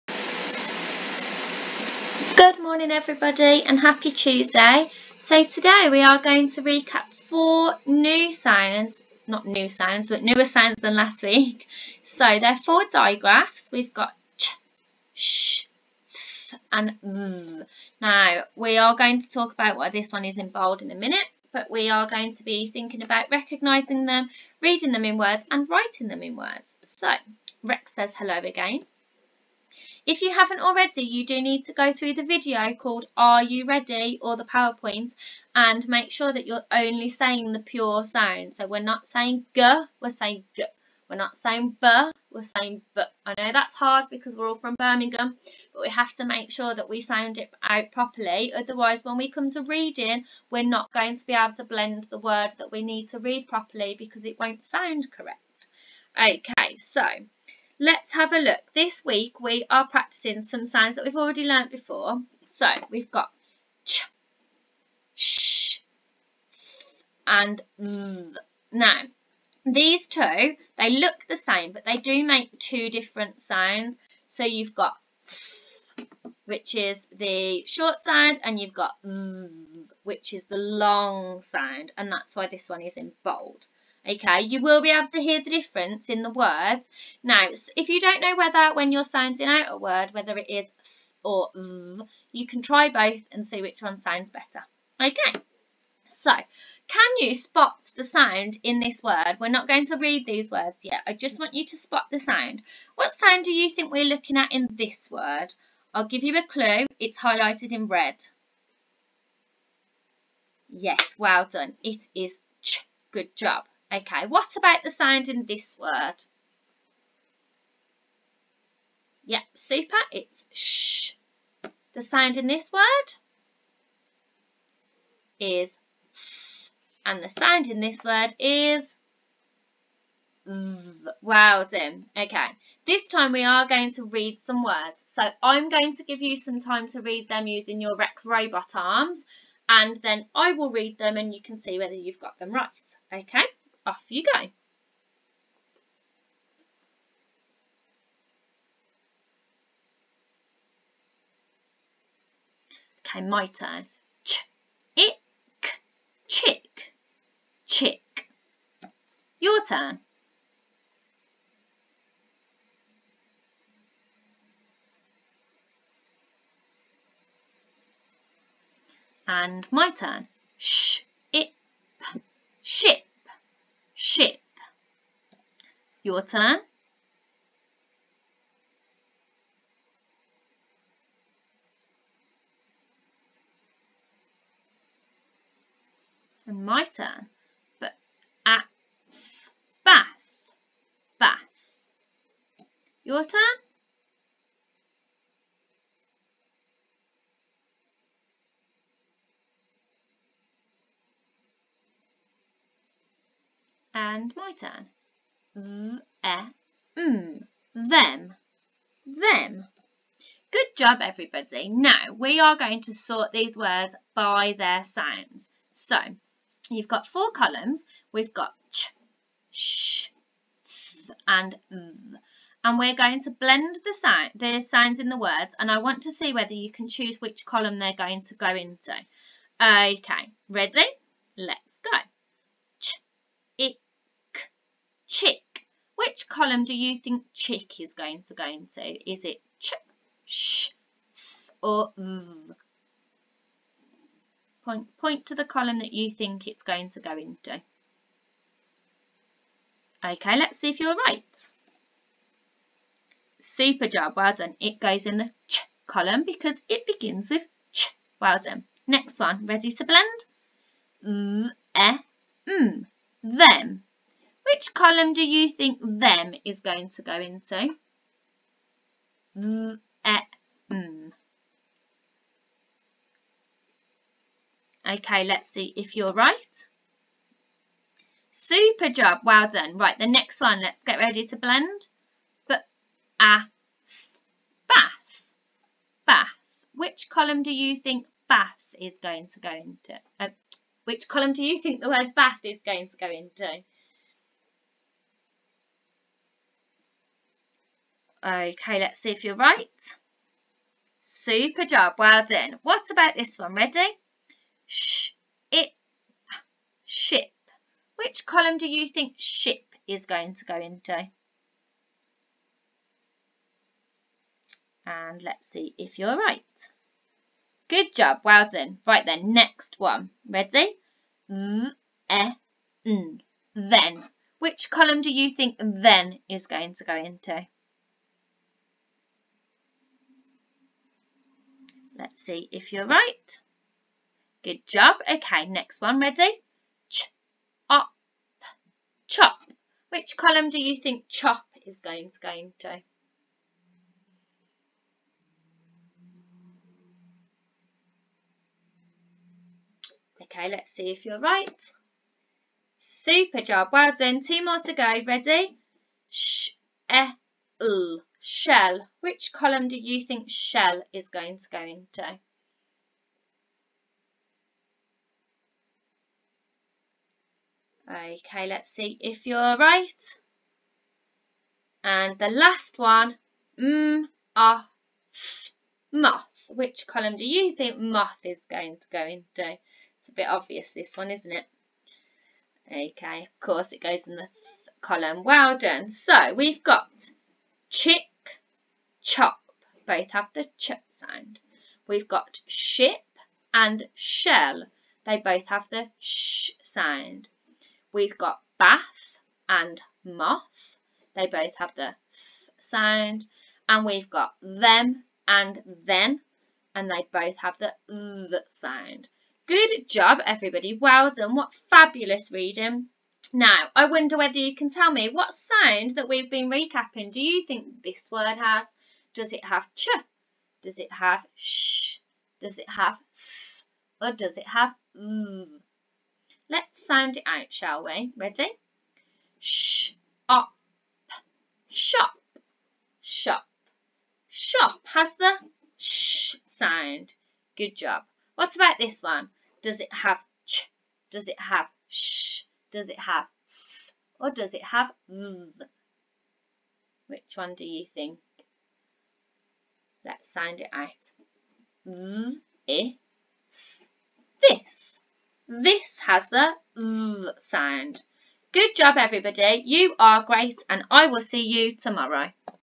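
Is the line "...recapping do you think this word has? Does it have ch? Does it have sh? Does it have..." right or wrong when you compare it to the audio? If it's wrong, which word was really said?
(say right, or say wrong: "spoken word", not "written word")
right.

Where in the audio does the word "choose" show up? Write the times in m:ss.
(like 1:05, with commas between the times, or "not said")
3:46.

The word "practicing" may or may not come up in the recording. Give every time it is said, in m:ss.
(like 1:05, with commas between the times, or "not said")
0:59.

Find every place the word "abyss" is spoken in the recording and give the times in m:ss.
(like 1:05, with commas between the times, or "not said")
not said.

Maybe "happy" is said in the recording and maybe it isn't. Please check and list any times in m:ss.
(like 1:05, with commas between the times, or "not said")
0:03.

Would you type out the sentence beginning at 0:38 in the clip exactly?
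So we're not saying g, we're saying g.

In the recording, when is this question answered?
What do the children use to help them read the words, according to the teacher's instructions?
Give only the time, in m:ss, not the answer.
2:17.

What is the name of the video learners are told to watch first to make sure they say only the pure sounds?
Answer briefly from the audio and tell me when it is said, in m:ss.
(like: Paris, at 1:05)
Are You Ready, at 0:33.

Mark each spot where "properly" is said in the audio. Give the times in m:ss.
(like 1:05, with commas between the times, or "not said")
0:47, 0:53.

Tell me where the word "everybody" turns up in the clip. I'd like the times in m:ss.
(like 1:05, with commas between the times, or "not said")
0:02, 3:31, 6:50, 7:38.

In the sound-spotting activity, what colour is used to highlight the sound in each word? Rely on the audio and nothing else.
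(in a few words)
red.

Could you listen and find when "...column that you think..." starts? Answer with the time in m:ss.
4:05.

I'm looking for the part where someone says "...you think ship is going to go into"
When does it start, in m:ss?
5:08.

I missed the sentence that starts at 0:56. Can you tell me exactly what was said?
Okay, so let's have a look.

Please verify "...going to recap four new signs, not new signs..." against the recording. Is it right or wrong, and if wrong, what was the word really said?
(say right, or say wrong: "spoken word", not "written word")
right.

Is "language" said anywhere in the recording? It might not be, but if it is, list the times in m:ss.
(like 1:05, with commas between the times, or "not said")
not said.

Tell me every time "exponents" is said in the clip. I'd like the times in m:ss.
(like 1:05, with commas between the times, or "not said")
not said.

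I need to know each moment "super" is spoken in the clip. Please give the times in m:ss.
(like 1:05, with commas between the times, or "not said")
1:59, 4:13, 4:38, 5:01, 5:52.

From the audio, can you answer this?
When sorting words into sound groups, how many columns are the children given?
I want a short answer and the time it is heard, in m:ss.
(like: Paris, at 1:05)
4, at 3:37.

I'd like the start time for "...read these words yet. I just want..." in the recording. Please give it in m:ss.
1:39.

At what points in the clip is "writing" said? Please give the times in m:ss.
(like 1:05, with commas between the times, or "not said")
0:25.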